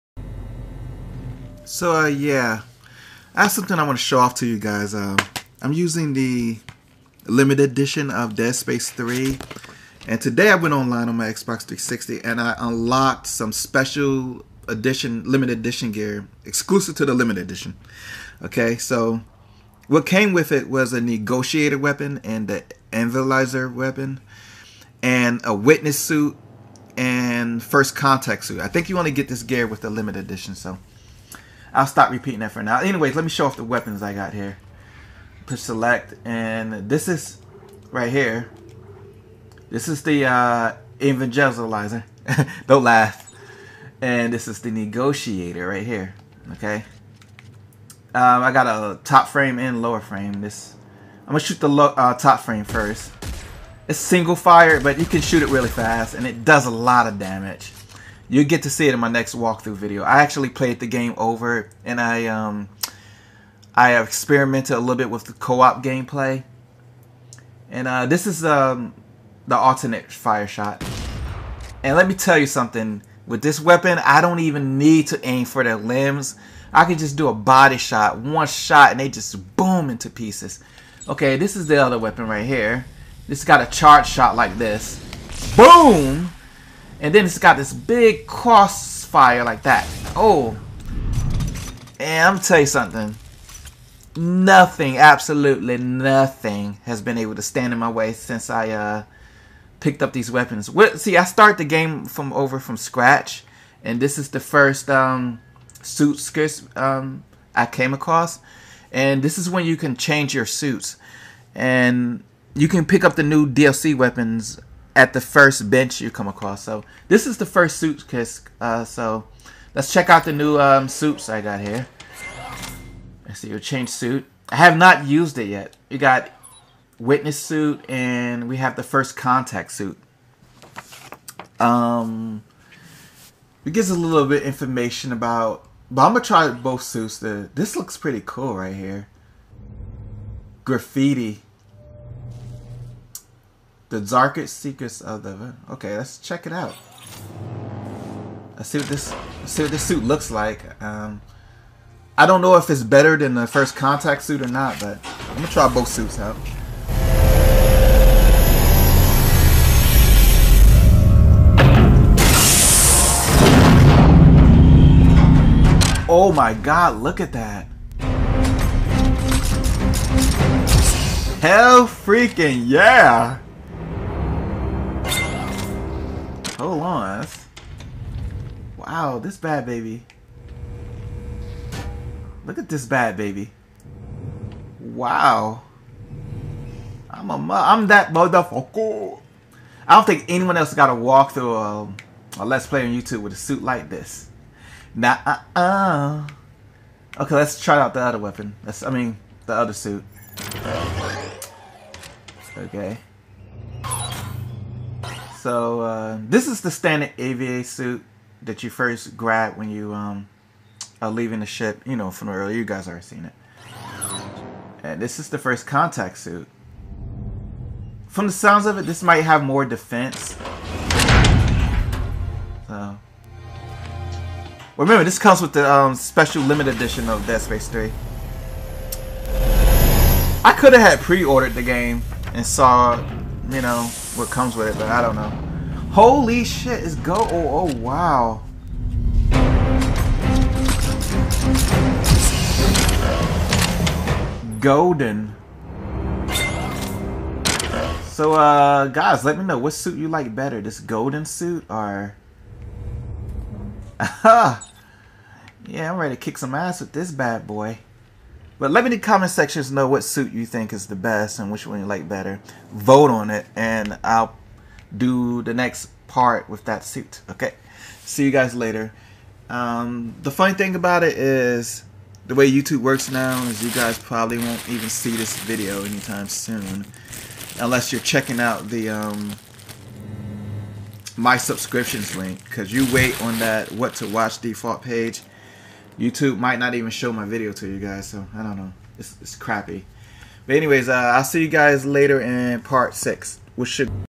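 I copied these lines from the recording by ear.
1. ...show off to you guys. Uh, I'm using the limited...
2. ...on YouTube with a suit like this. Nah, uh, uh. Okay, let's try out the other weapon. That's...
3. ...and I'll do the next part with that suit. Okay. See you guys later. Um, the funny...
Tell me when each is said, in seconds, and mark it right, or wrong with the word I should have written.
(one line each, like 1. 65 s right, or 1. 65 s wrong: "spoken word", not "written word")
1. 4 s right
2. 192 s right
3. 263 s right.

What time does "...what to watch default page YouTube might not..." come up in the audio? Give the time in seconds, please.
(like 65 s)
283 s.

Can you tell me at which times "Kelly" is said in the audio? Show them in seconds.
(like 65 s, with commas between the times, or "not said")
not said.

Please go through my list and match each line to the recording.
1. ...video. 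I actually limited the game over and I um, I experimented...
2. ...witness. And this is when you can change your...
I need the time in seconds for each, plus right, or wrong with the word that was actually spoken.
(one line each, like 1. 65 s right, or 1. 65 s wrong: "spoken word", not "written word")
1. 59 s wrong: "played", not "limited"
2. 107 s wrong: "across", not "witness".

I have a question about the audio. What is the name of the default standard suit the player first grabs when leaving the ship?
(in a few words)
AVA suit.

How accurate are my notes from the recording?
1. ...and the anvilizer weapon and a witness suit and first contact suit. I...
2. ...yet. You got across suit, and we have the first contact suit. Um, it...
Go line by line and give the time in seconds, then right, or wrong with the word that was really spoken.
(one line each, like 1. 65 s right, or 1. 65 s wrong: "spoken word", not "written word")
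1. 22 s right
2. 125 s wrong: "witness", not "across".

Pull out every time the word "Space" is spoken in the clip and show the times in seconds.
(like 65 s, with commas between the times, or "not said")
8 s, 227 s.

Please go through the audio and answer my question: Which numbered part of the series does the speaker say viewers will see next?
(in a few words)
part 6.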